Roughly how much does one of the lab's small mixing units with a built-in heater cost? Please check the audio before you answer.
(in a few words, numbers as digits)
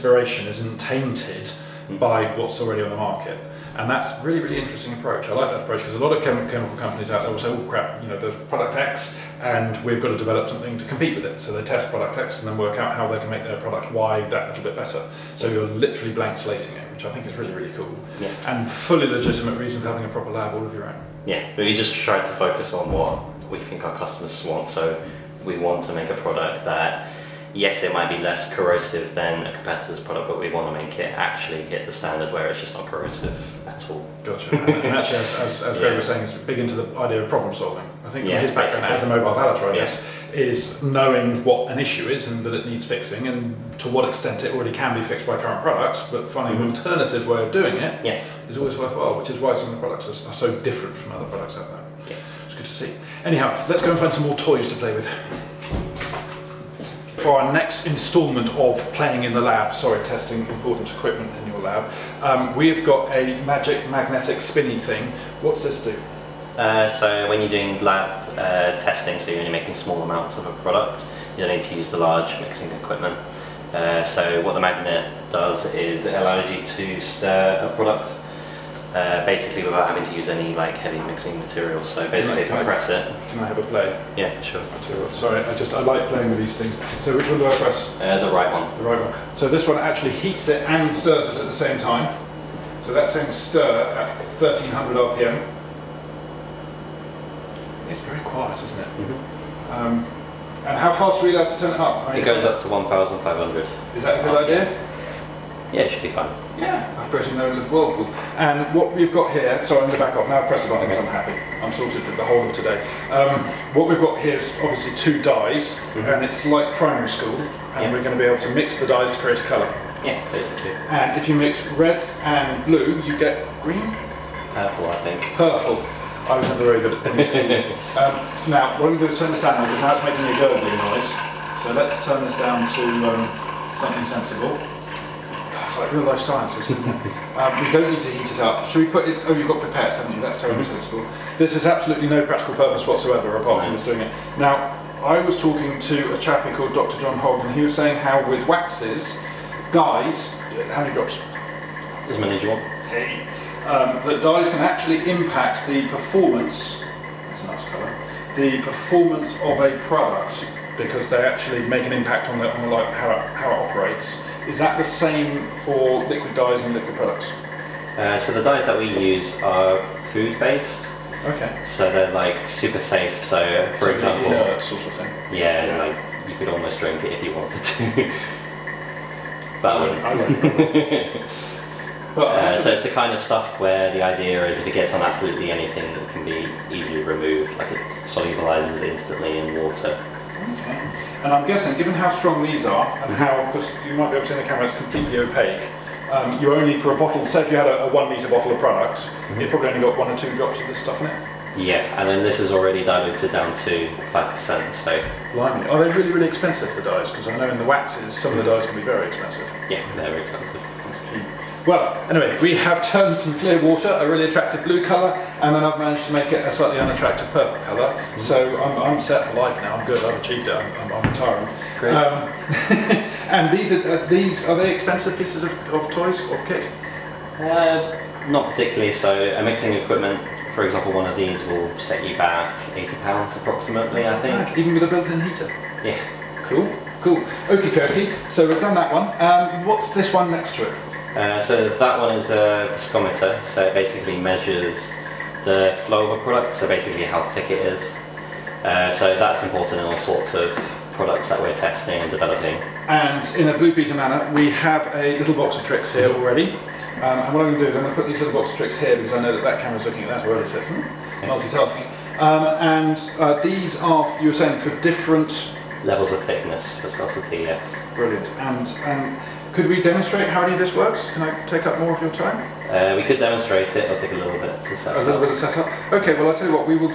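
£80.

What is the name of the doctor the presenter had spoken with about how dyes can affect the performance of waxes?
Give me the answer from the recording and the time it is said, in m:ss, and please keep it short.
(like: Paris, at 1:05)
Dr. John Hogg, at 2:26.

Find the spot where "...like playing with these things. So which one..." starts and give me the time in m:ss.
1:25.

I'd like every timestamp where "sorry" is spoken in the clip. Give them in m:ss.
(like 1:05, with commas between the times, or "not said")
0:59, 1:25, 1:49.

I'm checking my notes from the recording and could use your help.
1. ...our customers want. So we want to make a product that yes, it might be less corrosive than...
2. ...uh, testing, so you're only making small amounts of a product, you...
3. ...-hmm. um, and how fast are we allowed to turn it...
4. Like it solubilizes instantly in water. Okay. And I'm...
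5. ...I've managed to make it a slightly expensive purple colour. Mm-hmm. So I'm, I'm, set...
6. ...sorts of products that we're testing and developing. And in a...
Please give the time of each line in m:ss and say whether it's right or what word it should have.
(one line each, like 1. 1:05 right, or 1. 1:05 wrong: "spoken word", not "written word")
1. 0:23 right
2. 1:08 right
3. 1:39 right
4. 3:07 right
5. 3:35 wrong: "unattractive", not "expensive"
6. 4:09 right.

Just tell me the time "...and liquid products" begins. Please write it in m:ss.
2:46.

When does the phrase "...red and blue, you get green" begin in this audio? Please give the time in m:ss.
2:01.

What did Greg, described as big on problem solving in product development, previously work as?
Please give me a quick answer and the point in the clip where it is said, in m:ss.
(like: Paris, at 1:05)
Mobile valeter, at 0:39.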